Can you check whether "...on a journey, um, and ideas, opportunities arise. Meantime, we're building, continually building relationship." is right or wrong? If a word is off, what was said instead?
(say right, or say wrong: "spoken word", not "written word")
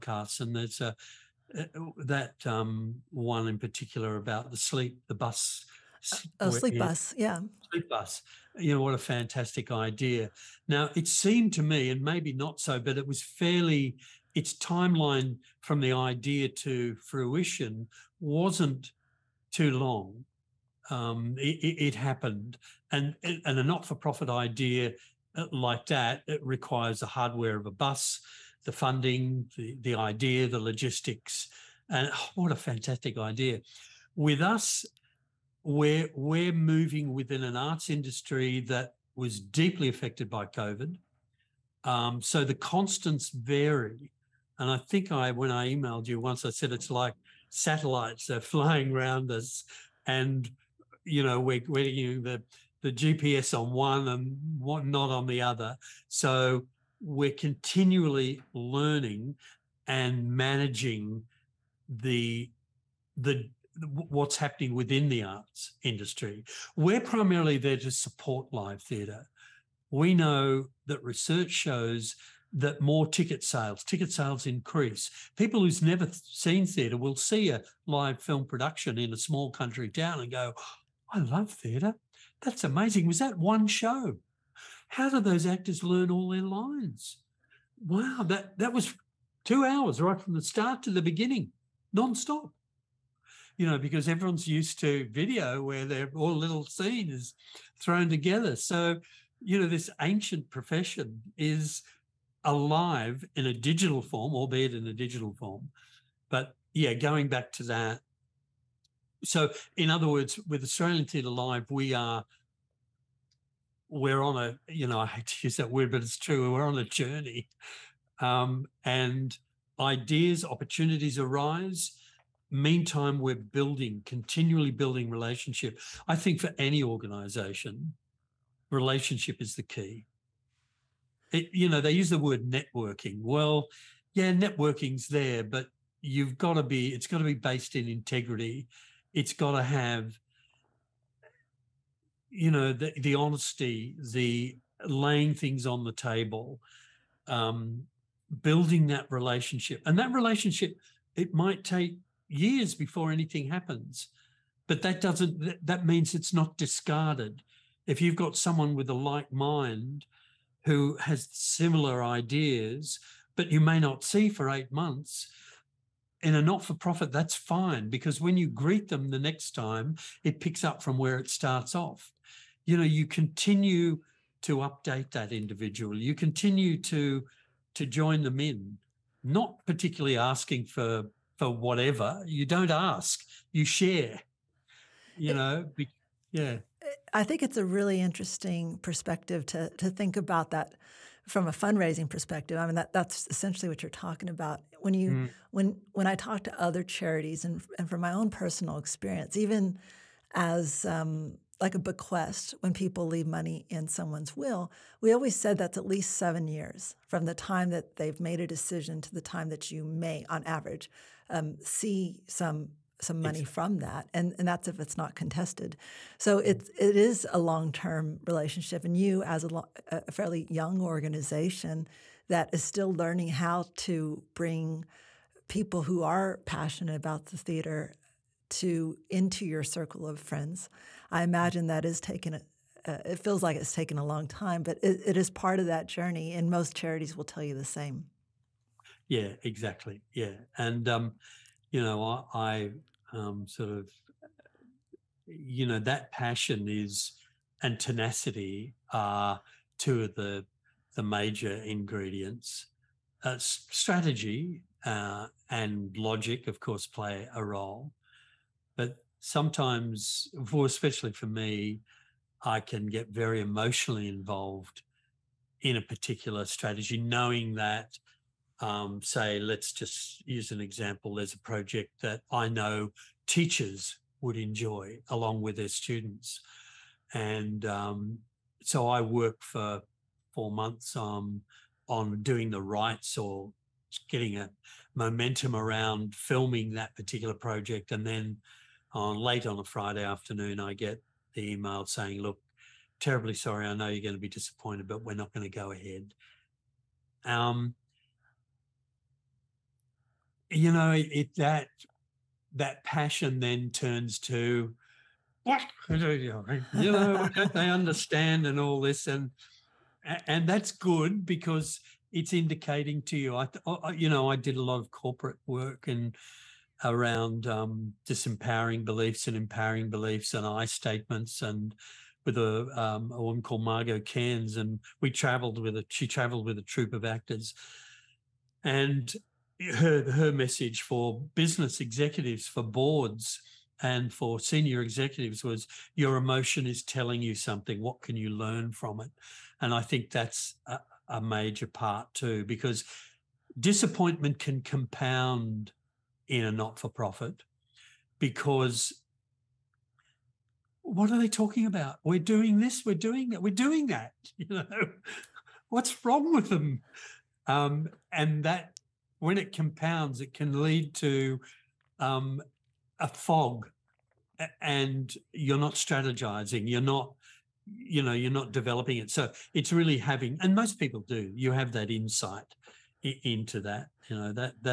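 right.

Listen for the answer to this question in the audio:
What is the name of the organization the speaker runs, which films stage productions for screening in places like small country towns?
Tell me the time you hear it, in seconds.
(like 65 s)
110 s.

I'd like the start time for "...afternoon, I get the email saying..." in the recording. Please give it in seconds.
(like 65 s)
290 s.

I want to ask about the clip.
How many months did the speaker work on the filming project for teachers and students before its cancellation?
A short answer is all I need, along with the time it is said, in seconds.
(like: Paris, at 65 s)
4, at 280 s.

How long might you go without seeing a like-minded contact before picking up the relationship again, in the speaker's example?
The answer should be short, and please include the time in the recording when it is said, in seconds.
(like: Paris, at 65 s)
8 months, at 164 s.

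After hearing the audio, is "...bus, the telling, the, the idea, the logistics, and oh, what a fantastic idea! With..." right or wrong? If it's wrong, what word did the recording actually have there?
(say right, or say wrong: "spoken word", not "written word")
wrong: "funding", not "telling".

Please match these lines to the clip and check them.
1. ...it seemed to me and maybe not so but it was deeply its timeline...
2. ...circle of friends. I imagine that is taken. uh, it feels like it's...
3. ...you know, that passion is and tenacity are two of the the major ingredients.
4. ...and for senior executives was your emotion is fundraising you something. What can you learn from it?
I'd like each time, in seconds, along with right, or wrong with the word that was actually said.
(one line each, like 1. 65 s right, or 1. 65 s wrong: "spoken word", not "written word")
1. 10 s wrong: "fairly", not "deeply"
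2. 229 s right
3. 245 s right
4. 333 s wrong: "telling", not "fundraising".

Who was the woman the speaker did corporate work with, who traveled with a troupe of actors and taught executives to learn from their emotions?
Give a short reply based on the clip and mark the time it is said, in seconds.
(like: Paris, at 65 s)
Margot Cairnes, at 323 s.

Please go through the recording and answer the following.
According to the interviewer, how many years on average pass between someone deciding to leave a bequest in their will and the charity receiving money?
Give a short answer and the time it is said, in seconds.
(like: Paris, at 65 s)
7, at 206 s.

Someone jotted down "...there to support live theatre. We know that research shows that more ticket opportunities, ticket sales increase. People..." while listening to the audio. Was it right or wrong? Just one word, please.
wrong.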